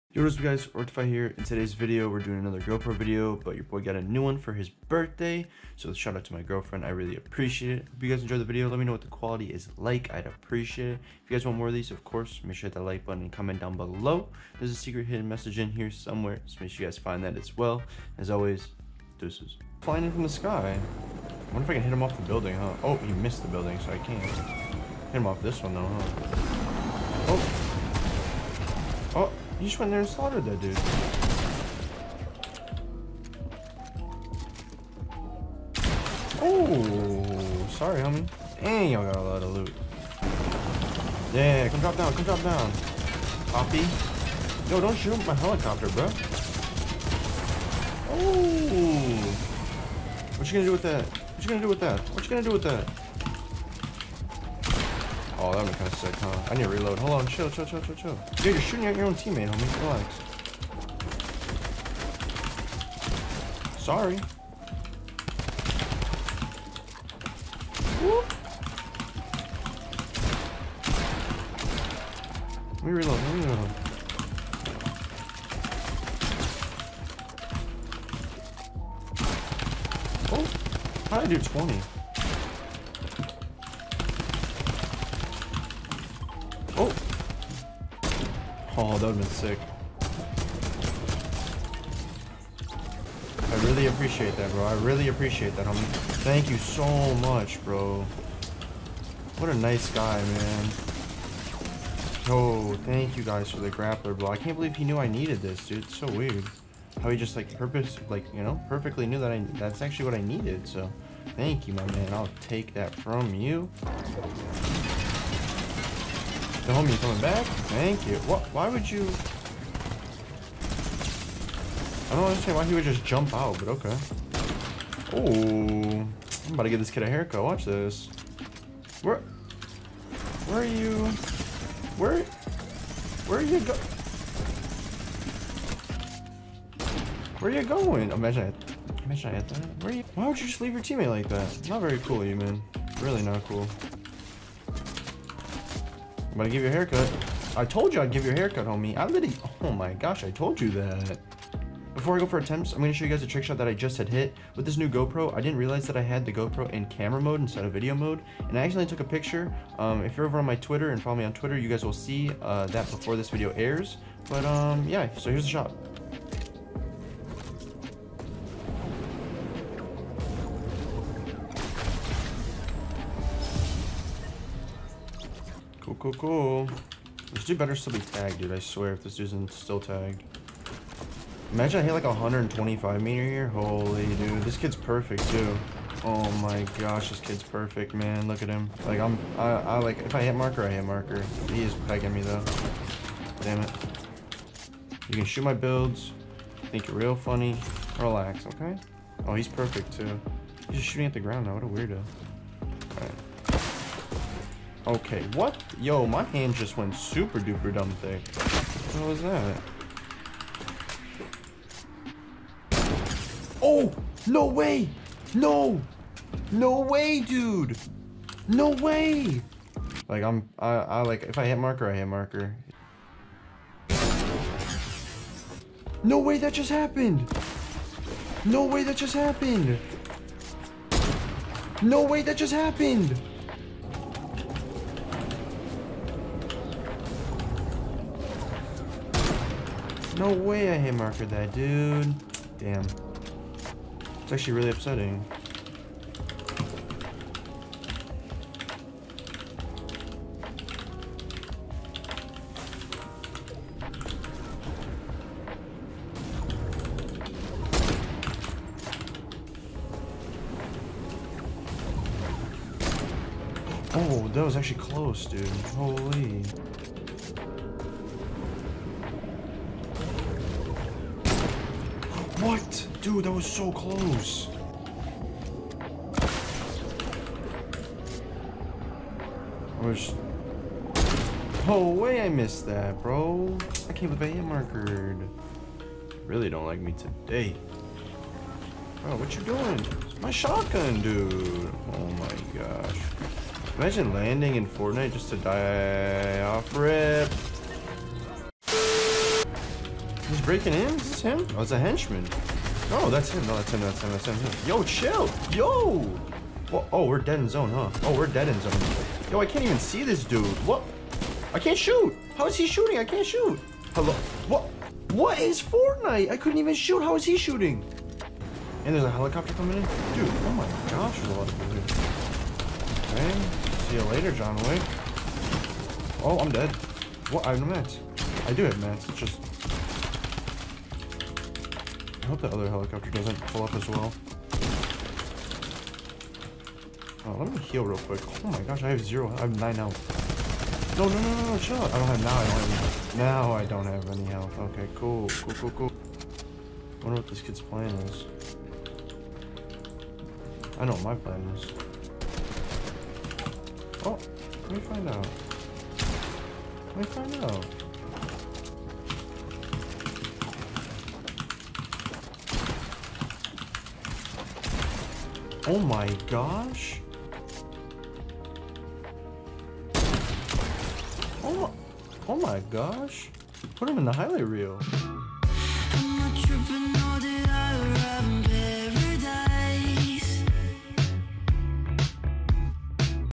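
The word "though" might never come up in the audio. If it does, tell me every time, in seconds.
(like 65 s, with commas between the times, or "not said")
25 s, 192 s.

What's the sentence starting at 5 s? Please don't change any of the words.
So shout out to my girlfriend, I really appreciate it.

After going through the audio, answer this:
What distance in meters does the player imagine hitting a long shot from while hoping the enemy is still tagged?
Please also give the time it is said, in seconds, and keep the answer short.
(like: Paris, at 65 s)
125 meters, at 182 s.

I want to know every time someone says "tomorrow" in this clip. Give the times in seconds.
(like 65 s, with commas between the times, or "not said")
not said.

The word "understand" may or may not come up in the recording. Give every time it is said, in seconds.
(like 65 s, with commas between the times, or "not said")
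122 s.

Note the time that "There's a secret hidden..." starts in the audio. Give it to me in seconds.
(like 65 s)
14 s.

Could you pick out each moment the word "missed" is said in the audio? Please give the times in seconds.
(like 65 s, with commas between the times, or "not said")
23 s, 282 s.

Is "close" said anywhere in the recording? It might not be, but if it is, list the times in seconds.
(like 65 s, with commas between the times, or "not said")
264 s, 273 s.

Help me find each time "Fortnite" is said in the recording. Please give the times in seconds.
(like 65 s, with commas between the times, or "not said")
294 s, 315 s.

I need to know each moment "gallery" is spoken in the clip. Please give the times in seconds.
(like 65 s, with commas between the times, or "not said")
not said.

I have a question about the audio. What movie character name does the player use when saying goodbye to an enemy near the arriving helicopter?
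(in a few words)
John Wick.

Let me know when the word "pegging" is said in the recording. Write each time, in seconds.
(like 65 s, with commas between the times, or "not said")
191 s.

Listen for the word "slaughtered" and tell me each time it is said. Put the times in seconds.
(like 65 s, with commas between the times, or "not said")
30 s.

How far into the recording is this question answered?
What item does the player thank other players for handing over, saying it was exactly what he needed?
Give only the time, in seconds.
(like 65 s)
103 s.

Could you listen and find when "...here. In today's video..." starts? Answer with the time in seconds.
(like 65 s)
1 s.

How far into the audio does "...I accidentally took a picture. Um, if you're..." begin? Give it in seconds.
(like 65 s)
158 s.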